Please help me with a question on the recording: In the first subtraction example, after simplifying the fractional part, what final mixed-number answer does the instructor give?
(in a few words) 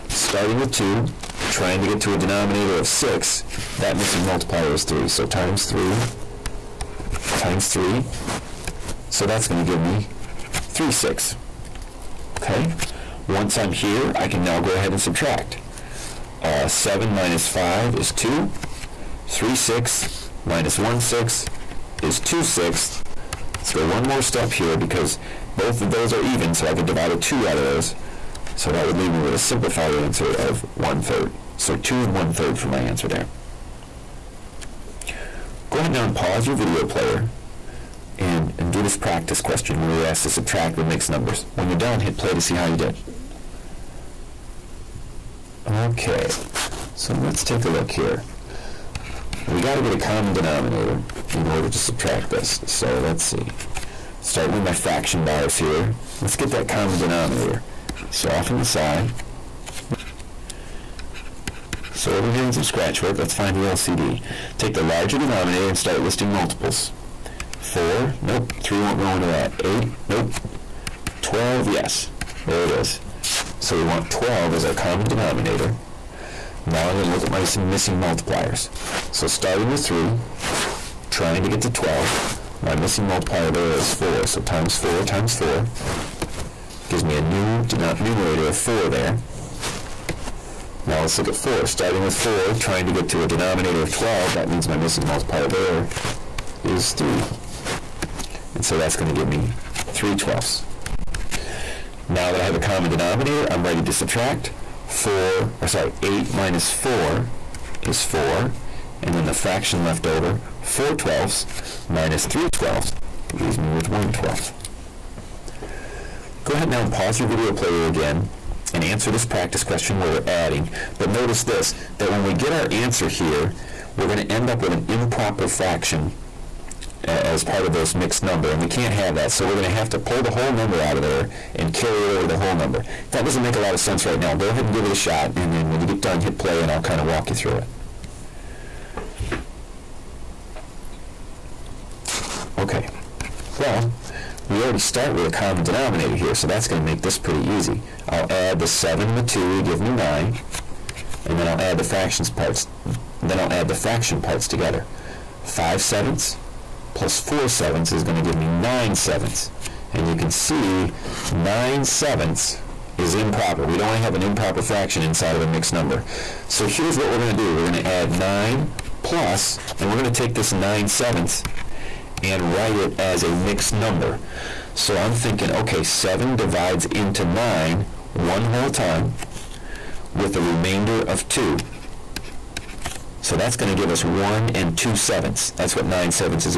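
2 and 1/3.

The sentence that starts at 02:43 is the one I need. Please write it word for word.
We don't want to have an improper fraction inside of a mixed number.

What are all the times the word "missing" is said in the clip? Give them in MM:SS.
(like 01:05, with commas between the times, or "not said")
00:03, 01:17, 01:22, 01:34.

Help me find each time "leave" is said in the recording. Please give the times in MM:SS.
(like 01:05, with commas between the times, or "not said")
00:28, 01:53.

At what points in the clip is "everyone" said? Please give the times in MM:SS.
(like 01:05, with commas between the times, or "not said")
not said.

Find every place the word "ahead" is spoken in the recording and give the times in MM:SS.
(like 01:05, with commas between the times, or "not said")
00:14, 00:35, 01:56, 02:14.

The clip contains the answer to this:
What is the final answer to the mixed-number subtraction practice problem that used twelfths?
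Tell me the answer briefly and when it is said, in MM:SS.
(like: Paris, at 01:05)
4 and 1/12, at 01:53.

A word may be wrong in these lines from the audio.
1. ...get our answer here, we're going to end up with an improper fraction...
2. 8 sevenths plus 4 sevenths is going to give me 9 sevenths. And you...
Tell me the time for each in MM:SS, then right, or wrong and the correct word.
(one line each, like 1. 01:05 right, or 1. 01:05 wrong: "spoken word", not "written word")
1. 02:02 right
2. 02:35 wrong: "5", not "8".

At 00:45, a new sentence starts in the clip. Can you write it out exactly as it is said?
Okay, so let's take a look here.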